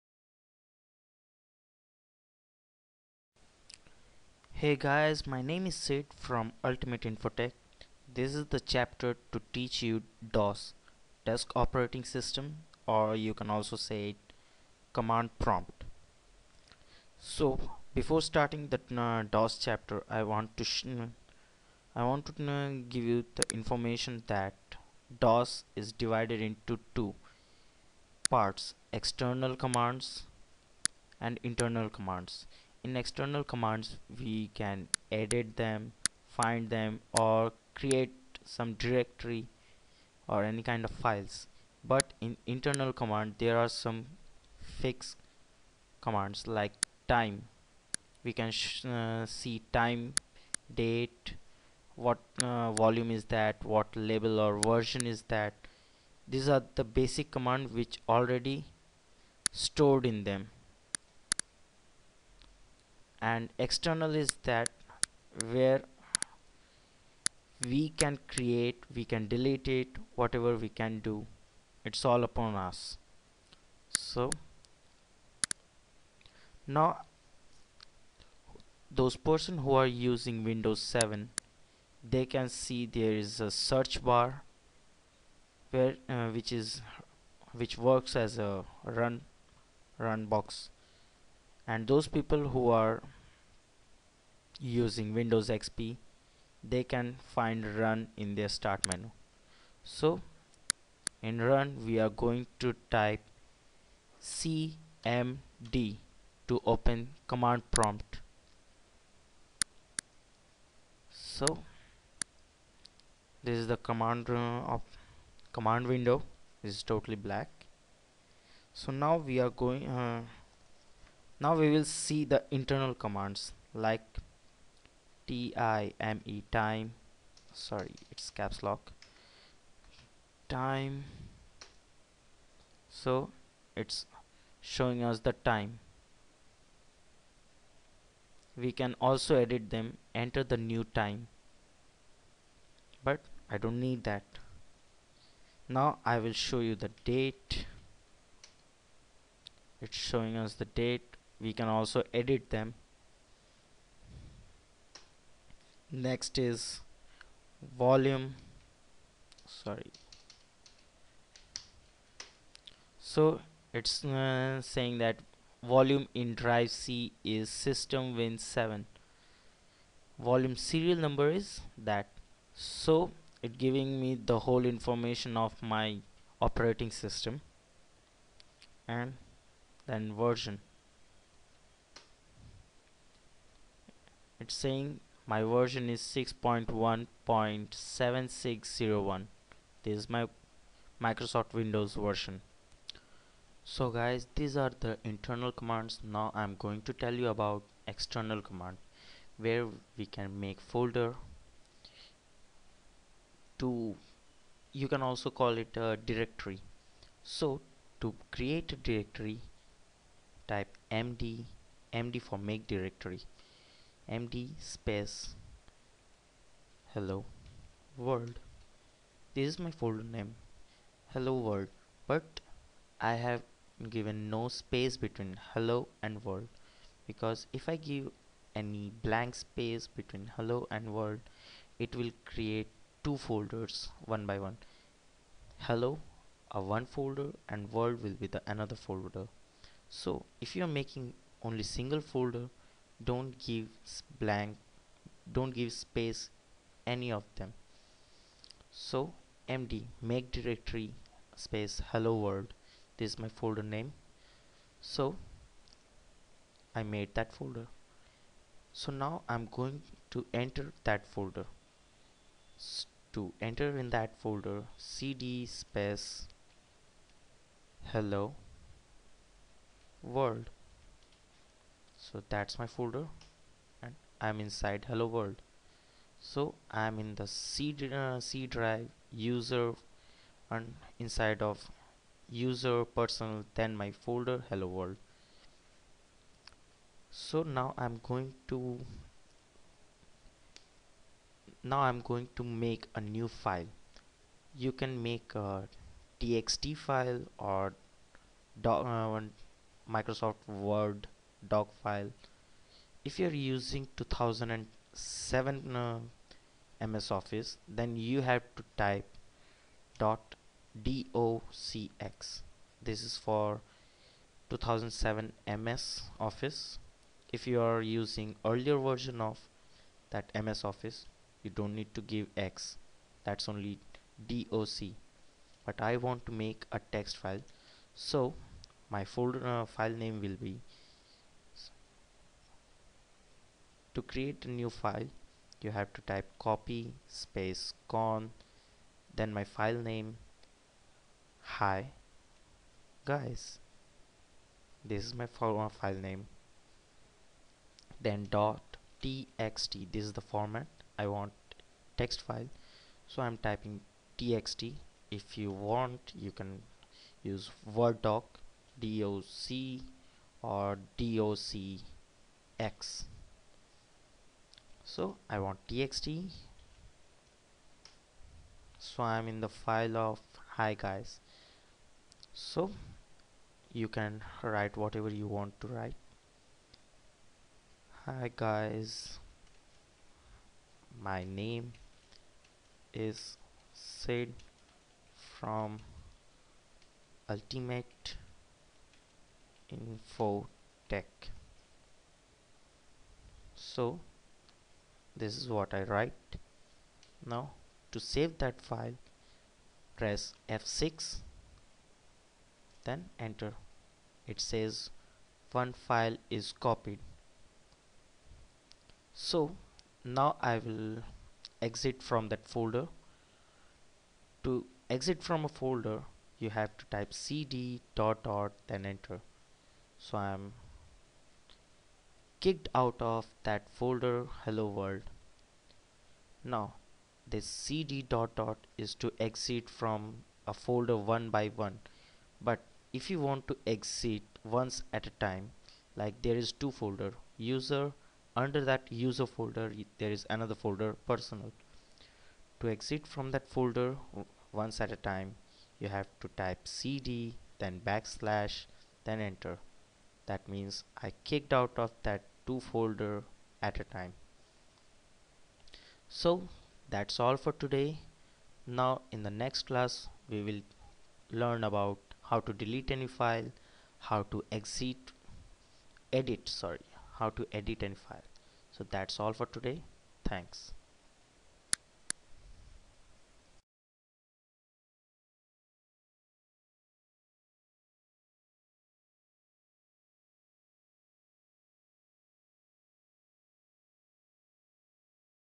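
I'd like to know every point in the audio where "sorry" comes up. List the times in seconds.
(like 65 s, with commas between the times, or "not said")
127 s, 159 s, 466 s.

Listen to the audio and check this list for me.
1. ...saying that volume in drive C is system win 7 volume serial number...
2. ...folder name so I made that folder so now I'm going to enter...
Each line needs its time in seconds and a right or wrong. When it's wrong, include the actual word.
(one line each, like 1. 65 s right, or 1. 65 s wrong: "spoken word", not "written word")
1. 164 s right
2. 253 s right.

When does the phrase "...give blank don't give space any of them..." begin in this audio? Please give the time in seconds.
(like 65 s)
243 s.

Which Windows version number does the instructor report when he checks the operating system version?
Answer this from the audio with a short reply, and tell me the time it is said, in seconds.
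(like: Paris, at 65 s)
6.1.7601, at 186 s.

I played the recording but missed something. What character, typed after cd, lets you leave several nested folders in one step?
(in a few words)
backslash.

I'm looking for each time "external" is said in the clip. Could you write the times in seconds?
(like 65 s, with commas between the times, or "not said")
28 s, 32 s, 63 s, 197 s.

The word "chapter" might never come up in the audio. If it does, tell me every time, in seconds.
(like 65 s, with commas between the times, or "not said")
8 s, 19 s.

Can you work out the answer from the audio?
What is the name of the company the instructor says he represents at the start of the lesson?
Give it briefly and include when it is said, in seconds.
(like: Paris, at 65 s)
Ultimate Infotech, at 6 s.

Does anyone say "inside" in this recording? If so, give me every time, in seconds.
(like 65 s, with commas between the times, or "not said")
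274 s, 280 s.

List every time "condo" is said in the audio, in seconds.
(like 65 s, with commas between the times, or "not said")
not said.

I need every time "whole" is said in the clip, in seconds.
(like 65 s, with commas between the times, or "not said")
174 s.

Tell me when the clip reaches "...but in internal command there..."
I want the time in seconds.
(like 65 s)
41 s.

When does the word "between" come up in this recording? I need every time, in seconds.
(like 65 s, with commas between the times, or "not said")
224 s, 229 s.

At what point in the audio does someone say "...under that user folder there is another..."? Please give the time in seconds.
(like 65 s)
438 s.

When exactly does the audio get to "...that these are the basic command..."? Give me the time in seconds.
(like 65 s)
55 s.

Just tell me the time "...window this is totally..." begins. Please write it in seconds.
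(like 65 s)
115 s.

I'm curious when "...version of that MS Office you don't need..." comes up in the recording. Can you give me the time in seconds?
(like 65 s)
318 s.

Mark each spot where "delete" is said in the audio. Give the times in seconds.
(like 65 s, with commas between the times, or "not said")
69 s, 462 s.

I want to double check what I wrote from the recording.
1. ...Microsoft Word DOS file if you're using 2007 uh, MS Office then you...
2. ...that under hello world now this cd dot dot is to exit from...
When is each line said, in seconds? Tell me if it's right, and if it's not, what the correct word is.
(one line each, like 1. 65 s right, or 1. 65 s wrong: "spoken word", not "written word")
1. 299 s wrong: "Doc", not "DOS"
2. 423 s wrong: "folder", not "under".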